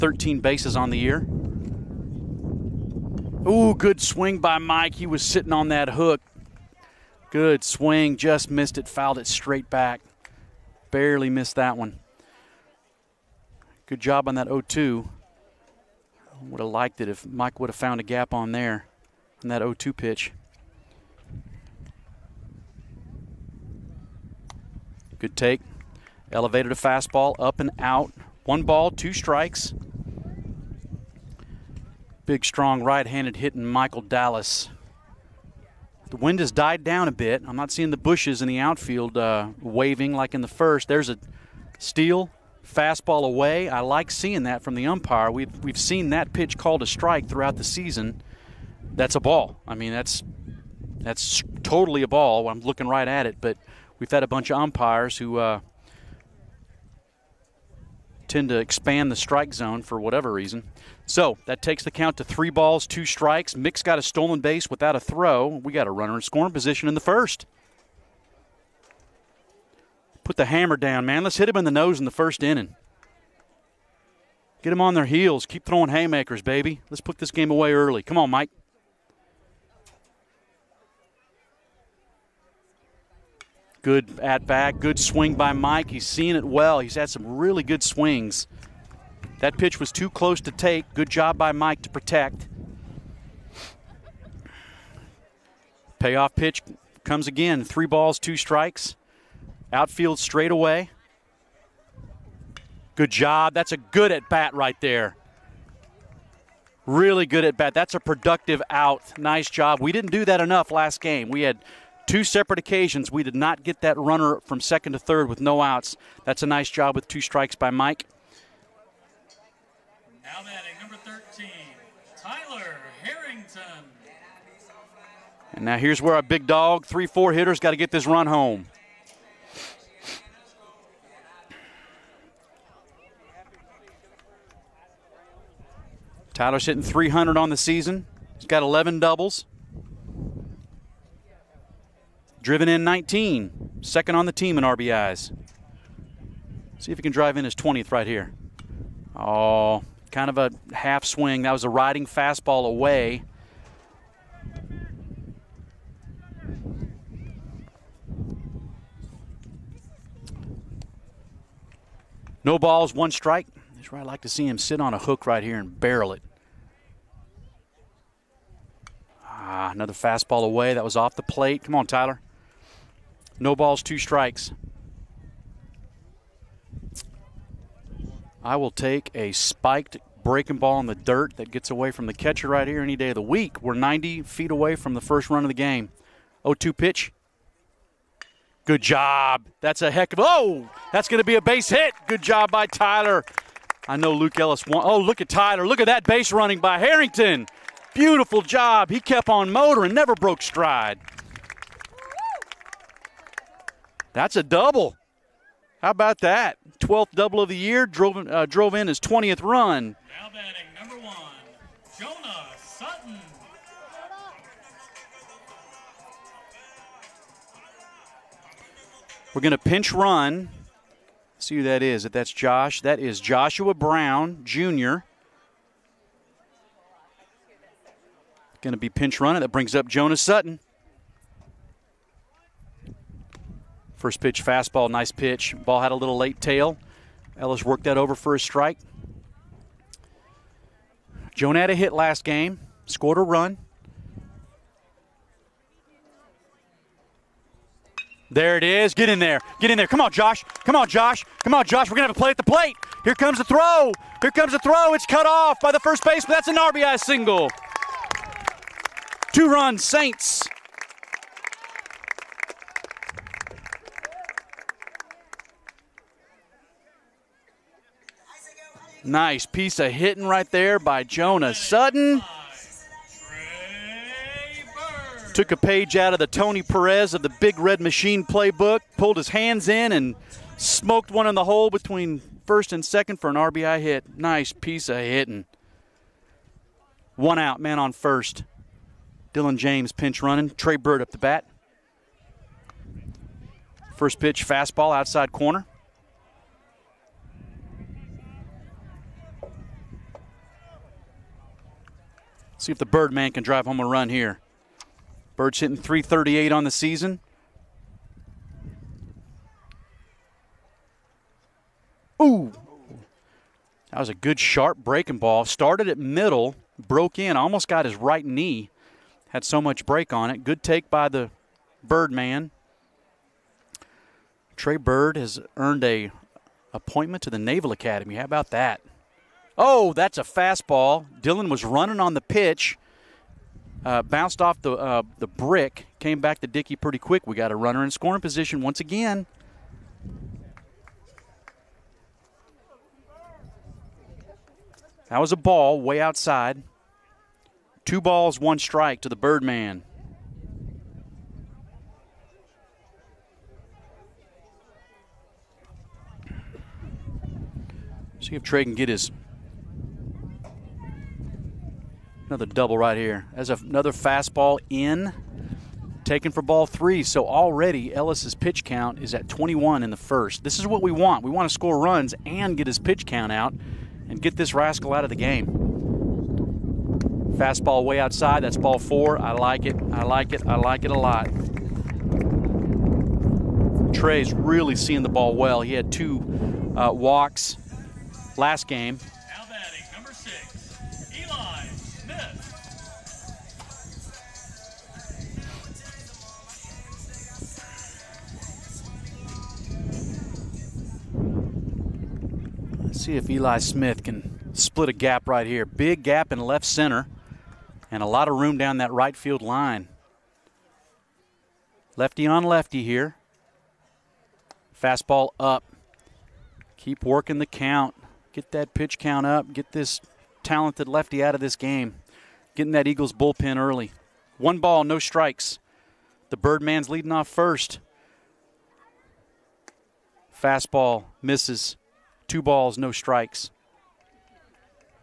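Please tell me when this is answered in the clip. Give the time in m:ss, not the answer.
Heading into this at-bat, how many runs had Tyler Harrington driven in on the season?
2:22.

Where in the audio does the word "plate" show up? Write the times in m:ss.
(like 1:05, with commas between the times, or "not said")
2:51, 4:12.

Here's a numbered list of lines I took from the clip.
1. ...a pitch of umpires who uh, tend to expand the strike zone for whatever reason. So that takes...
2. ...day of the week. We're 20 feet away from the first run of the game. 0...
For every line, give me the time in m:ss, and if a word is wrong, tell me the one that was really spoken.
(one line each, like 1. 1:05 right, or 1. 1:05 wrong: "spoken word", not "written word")
1. 0:54 wrong: "bunch", not "pitch"
2. 3:02 wrong: "90", not "20".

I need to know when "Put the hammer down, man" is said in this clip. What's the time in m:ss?
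1:10.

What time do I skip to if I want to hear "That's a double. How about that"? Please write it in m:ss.
3:24.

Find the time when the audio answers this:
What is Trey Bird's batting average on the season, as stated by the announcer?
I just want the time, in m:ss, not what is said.
5:05.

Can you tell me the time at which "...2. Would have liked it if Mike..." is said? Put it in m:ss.
0:14.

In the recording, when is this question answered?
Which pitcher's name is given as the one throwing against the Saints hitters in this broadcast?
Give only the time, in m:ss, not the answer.
3:14.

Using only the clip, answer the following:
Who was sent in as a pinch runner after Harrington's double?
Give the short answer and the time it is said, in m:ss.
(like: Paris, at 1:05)
Joshua Brown Jr., at 3:43.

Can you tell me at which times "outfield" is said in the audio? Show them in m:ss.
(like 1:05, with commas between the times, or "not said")
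0:38, 1:39.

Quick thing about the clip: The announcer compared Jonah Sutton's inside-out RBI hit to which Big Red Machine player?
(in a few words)
Tony Perez.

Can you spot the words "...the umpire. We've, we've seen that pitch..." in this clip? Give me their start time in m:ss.
0:44.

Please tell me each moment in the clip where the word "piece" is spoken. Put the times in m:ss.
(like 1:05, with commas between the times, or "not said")
4:29, 4:44.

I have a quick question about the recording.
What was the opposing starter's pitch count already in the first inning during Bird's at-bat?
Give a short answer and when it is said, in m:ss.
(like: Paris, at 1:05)
21, at 6:09.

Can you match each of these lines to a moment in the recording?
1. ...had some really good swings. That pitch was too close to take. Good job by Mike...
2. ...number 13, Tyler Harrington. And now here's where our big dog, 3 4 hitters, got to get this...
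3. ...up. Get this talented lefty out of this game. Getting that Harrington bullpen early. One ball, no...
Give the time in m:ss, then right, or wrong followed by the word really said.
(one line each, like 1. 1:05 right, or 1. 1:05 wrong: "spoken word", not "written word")
1. 1:26 right
2. 2:00 right
3. 6:59 wrong: "Eagles", not "Harrington".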